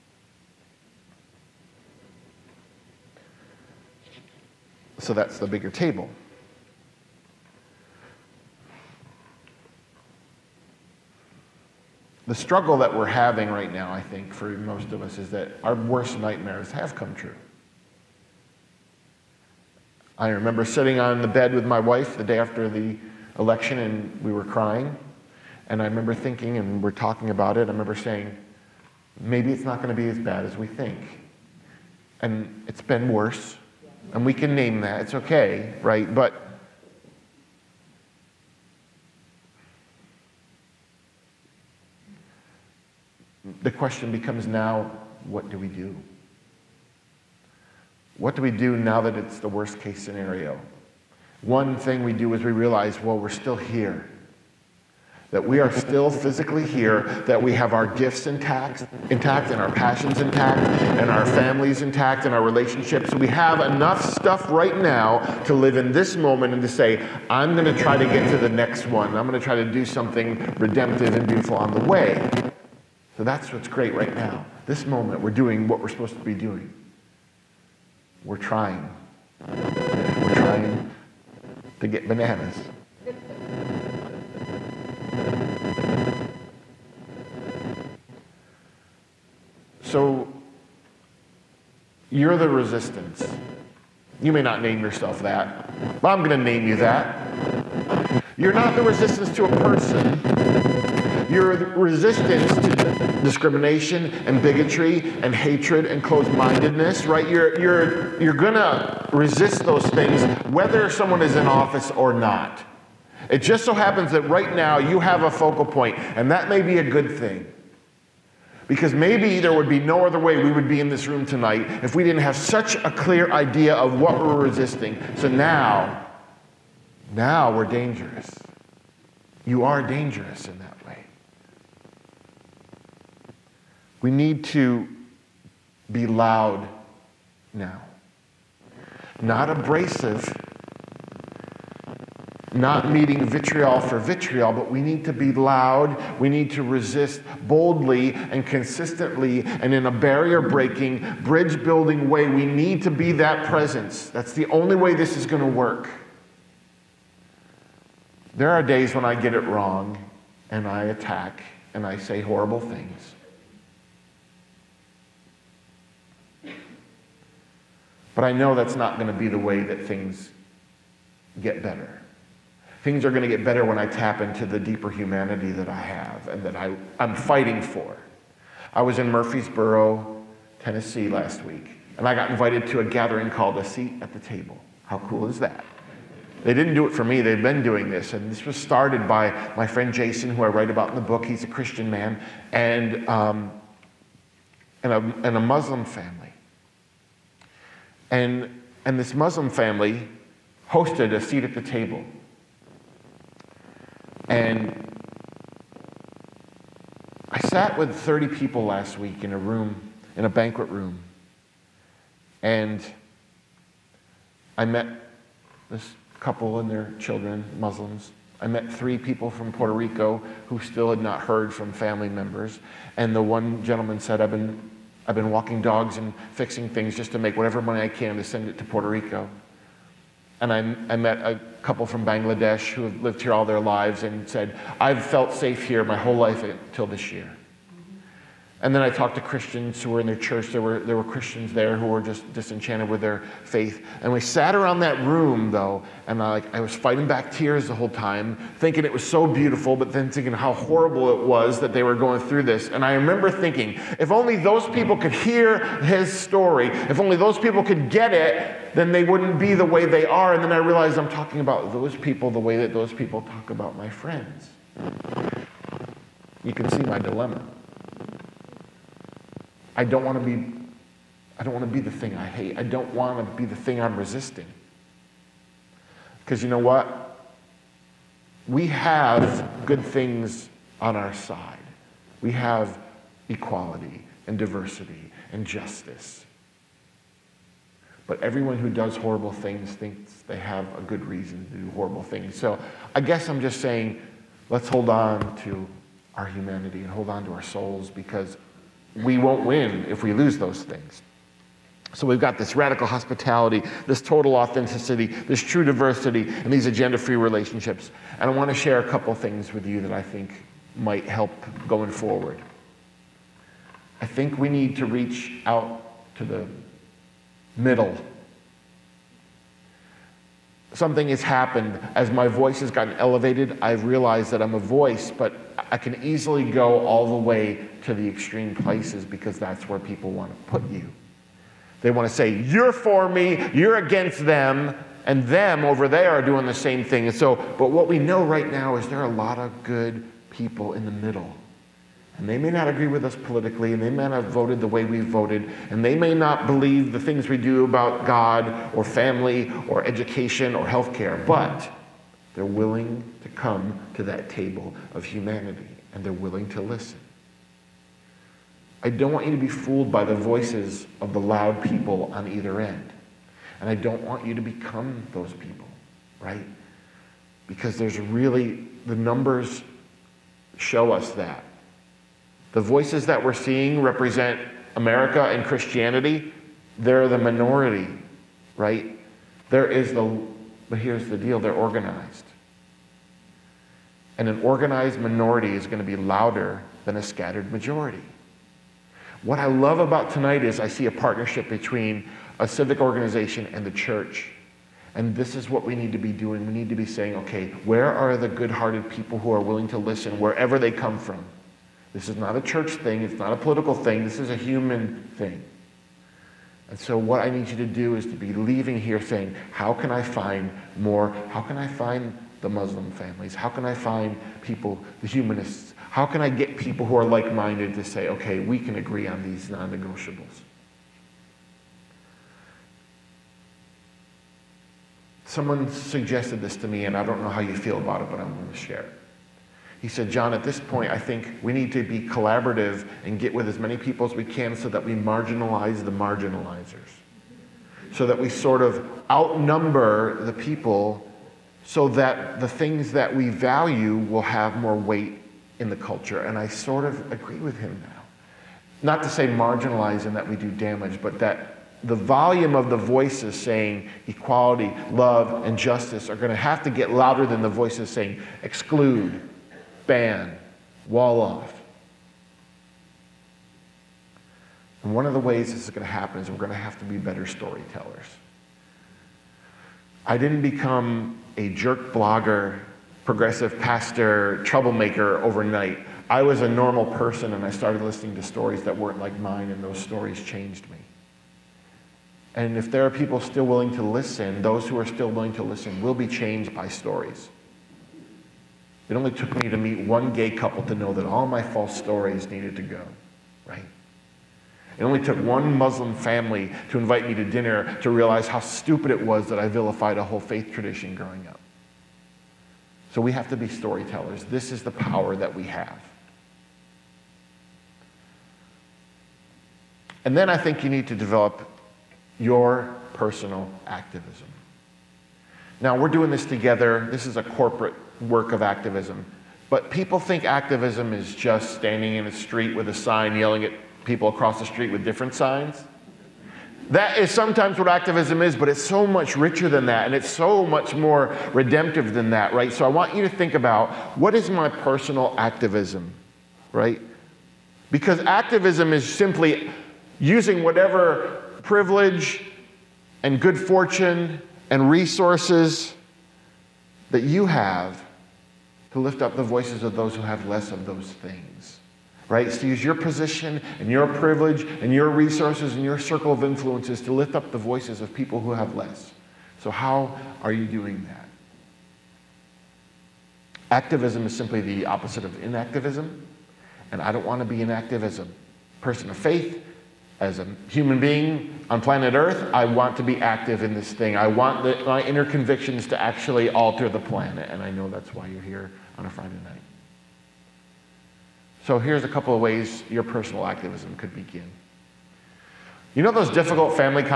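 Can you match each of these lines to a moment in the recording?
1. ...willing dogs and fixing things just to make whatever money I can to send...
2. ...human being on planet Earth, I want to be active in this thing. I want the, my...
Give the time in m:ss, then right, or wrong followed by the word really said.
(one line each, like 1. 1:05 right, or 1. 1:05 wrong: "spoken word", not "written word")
1. 3:45 wrong: "walking", not "willing"
2. 9:30 right.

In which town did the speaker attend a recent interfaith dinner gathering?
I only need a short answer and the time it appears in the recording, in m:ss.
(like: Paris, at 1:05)
Murfreesboro, at 2:59.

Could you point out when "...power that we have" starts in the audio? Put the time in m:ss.
8:24.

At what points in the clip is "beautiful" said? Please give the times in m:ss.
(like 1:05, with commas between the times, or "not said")
1:11, 4:09.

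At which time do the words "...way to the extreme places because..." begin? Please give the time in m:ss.
5:27.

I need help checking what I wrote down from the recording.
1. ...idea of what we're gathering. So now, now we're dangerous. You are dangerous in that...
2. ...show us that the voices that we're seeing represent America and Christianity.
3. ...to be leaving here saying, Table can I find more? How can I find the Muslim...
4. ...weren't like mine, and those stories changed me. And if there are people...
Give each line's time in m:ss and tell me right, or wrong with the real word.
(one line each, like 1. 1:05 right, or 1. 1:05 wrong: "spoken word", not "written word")
1. 2:03 wrong: "resisting", not "gathering"
2. 6:10 right
3. 6:48 wrong: "How", not "Table"
4. 7:58 right.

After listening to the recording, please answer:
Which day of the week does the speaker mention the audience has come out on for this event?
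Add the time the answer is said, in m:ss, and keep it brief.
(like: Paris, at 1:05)
Friday, at 9:38.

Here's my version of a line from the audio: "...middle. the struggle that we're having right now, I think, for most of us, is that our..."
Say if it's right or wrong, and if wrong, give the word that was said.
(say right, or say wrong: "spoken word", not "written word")
wrong: "table", not "middle".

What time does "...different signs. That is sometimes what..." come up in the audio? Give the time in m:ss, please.
8:44.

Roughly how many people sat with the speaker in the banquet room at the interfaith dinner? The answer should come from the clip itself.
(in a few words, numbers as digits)
30.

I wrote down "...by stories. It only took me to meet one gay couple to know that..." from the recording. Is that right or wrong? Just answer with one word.
right.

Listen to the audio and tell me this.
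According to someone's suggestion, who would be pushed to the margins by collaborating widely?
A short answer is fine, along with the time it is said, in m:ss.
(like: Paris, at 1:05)
the marginalizers, at 7:15.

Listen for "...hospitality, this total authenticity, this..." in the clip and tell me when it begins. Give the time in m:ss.
5:02.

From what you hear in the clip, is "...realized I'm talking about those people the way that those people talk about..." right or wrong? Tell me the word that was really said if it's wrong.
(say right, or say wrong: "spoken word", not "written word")
right.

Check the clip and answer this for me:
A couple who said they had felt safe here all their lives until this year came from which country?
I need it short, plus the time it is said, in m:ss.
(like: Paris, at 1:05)
Bangladesh, at 3:52.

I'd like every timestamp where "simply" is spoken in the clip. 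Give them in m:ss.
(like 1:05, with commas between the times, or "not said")
8:58, 9:24.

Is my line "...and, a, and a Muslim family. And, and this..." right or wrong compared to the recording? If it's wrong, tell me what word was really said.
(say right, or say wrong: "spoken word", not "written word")
right.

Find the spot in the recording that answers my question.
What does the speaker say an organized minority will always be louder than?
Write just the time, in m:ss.
6:26.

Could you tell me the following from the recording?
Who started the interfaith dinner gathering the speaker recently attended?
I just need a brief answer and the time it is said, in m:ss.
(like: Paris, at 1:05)
Jason, at 3:09.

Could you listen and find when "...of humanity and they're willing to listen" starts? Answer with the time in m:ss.
5:54.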